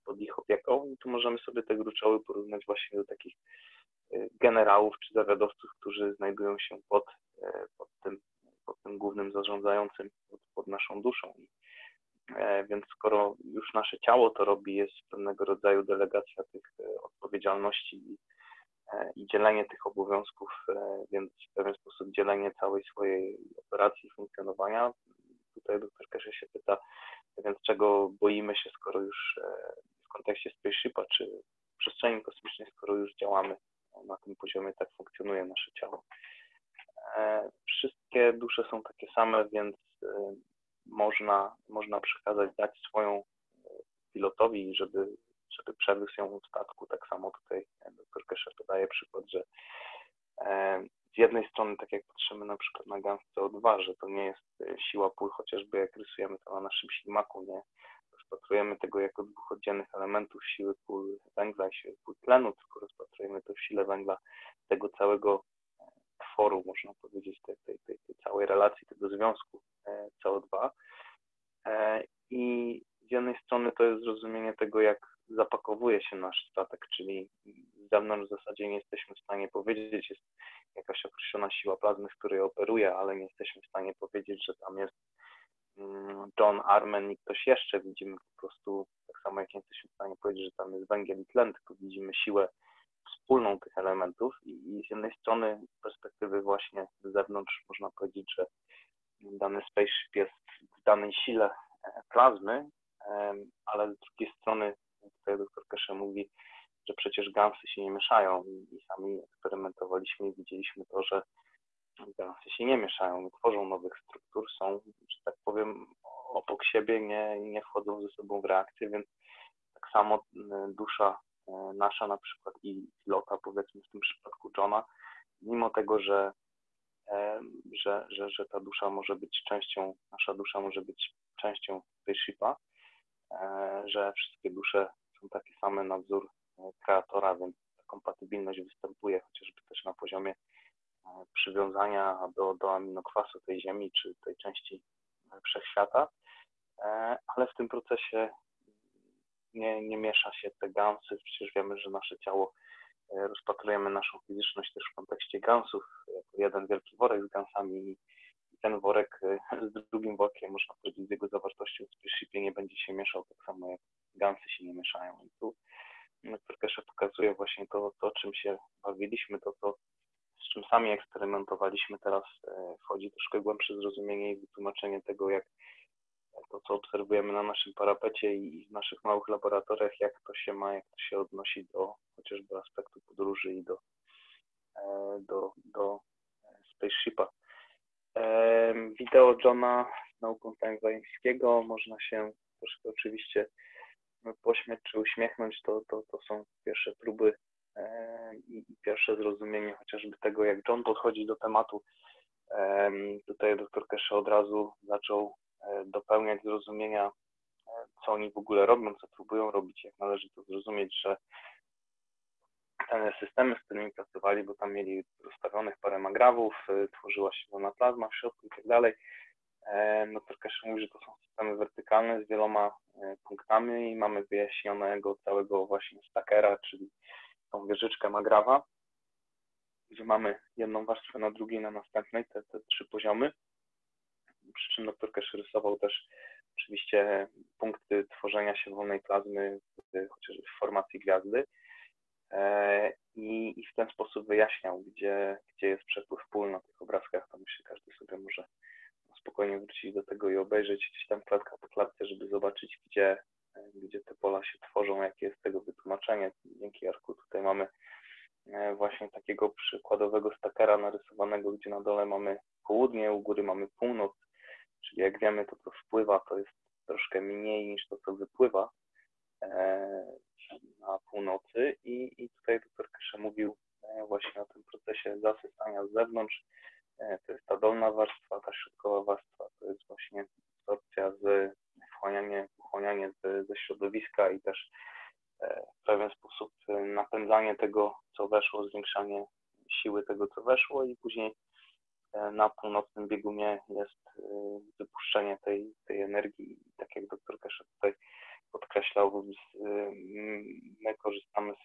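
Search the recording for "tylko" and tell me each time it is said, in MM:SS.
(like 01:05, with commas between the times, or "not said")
01:02, 01:31.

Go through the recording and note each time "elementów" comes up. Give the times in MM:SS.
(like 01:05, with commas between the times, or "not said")
00:59, 01:33.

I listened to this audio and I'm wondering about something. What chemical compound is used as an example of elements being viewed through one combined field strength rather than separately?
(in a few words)
CO2.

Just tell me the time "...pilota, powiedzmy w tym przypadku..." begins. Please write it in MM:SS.
02:03.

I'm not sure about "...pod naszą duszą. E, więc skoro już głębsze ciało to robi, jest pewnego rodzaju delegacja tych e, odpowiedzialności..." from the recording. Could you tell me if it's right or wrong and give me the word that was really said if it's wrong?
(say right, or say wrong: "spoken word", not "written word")
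wrong: "nasze", not "głębsze".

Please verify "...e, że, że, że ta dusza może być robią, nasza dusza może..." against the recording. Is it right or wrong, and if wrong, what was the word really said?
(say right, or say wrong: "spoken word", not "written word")
wrong: "częścią", not "robią".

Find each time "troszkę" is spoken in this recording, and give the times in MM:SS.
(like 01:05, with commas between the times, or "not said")
02:53, 03:12, 04:26.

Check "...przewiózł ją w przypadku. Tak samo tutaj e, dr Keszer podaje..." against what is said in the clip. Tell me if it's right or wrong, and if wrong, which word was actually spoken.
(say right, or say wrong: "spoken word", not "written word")
wrong: "statku", not "przypadku".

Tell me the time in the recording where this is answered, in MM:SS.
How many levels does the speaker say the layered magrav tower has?
03:52.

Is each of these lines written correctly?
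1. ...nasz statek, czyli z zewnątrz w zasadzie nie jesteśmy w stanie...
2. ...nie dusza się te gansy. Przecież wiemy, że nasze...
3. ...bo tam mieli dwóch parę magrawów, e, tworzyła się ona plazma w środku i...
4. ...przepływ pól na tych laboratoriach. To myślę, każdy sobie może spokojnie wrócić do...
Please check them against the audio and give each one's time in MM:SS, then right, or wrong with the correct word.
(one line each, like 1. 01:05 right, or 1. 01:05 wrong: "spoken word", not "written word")
1. 01:16 right
2. 02:29 wrong: "miesza", not "dusza"
3. 03:34 wrong: "rozstawionych", not "dwóch"
4. 04:05 wrong: "obrazkach", not "laboratoriach".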